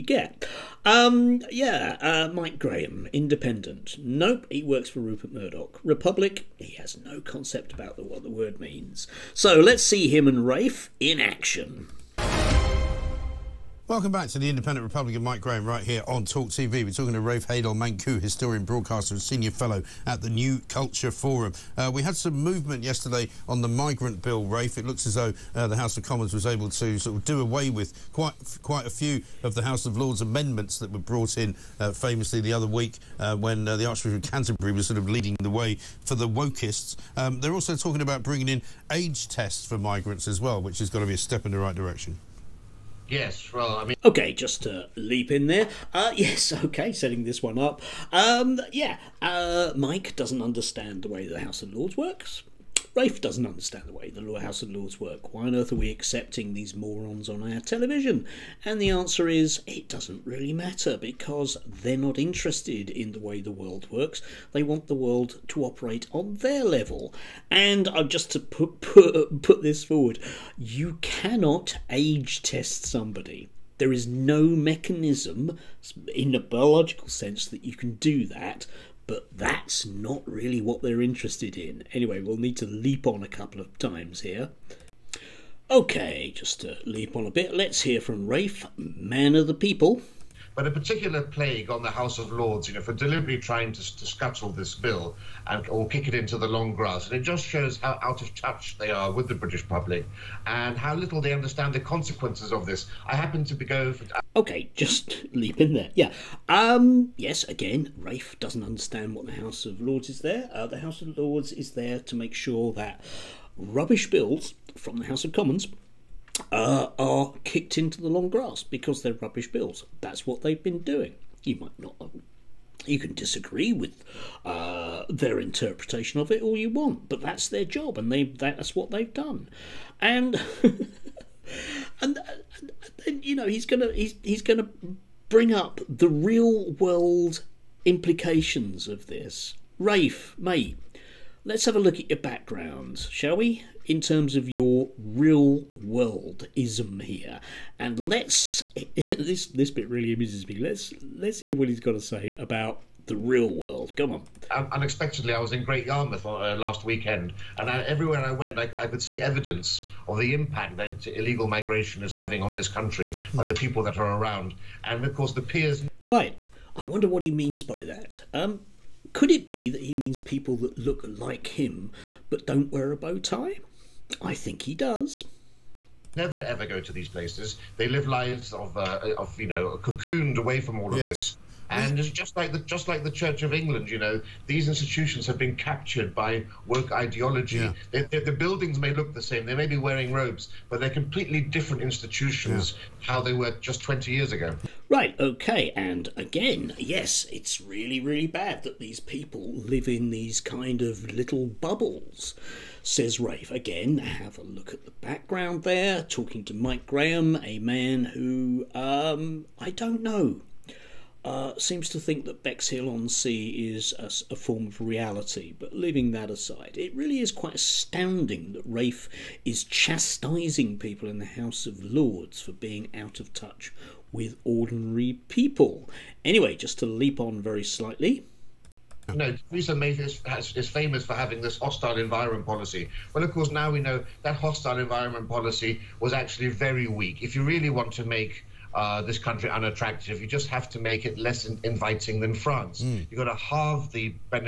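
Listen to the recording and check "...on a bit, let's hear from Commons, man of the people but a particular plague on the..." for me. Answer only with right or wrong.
wrong.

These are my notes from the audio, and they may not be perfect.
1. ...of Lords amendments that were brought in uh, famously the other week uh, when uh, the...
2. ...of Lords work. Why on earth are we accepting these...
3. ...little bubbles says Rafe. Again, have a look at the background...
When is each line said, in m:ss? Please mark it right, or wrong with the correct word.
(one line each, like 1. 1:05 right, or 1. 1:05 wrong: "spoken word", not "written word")
1. 0:29 right
2. 0:54 right
3. 3:21 right.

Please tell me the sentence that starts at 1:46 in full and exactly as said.
Um, yes, again, Rafe doesn't understand what the House of Lords is there.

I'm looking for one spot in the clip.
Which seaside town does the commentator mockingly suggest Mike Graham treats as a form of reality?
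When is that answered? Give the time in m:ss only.
3:32.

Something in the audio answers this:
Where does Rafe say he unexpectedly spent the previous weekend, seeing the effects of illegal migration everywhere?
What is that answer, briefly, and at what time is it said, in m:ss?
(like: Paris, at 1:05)
Great Yarmouth, at 2:35.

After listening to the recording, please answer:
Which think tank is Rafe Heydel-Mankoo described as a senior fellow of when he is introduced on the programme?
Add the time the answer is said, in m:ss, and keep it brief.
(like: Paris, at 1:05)
New Culture Forum, at 0:20.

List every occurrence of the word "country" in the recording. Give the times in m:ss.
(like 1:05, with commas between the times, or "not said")
2:42, 3:59.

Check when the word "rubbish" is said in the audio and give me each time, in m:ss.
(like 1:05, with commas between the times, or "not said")
1:53, 1:59.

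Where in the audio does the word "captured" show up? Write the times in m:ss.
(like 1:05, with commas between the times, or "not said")
3:05.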